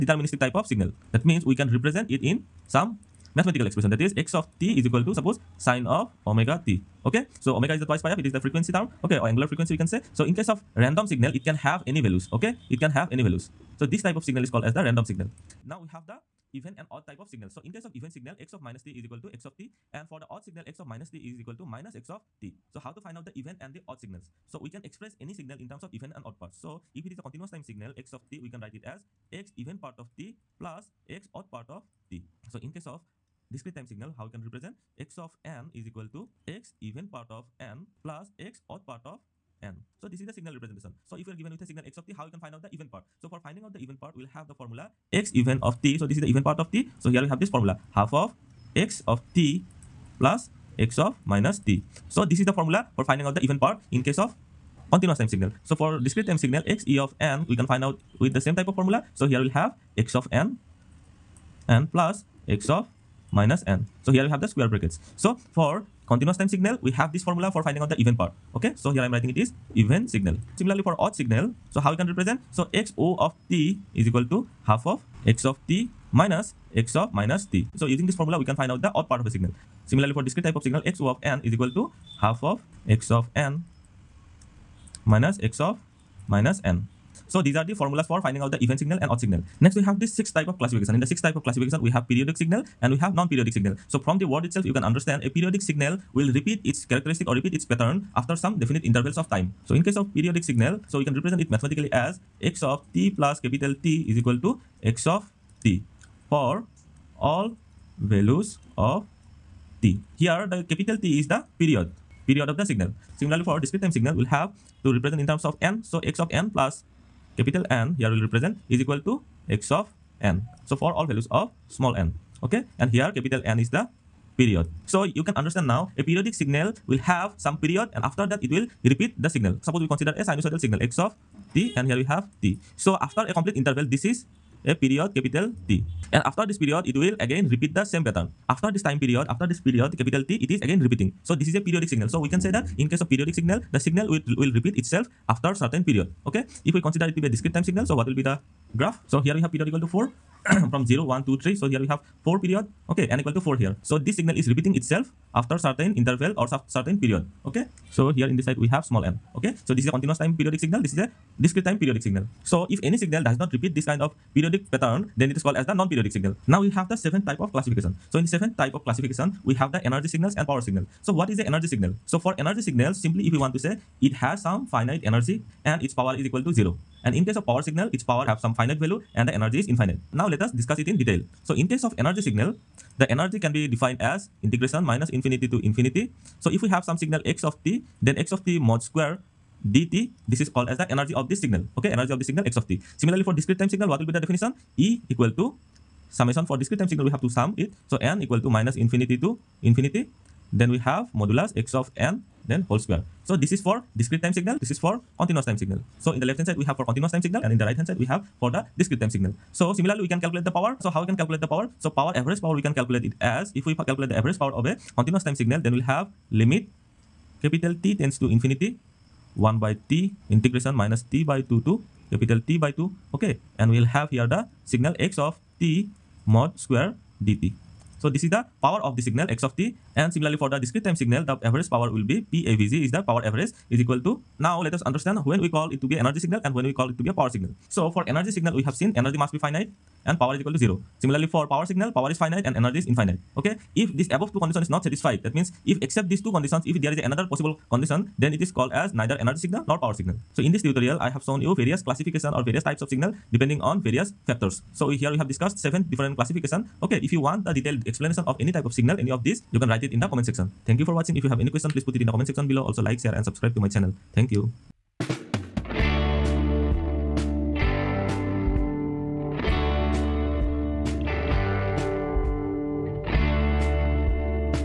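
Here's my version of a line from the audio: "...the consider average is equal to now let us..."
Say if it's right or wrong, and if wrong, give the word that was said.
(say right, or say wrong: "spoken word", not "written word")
wrong: "power", not "consider".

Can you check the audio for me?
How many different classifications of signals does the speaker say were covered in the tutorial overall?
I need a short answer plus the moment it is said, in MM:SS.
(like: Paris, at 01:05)
7, at 04:15.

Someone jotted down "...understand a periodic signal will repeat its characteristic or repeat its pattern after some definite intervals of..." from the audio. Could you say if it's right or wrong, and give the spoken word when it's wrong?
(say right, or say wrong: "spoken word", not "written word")
right.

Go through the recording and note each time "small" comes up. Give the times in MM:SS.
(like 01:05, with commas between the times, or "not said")
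02:01, 02:38.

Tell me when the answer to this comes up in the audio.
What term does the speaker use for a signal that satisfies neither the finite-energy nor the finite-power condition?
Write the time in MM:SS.
04:08.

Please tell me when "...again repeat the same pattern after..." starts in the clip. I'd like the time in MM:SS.
02:17.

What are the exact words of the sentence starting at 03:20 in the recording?
Then we have modulus x of n then whole square.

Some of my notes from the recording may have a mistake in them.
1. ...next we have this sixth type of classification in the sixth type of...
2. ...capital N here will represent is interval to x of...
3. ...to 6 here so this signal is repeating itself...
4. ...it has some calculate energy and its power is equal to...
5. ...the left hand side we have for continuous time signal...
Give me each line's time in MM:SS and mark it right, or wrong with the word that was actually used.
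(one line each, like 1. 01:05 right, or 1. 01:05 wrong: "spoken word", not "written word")
1. 01:29 right
2. 01:57 wrong: "equal", not "interval"
3. 02:33 wrong: "4", not "6"
4. 02:54 wrong: "finite", not "calculate"
5. 03:26 right.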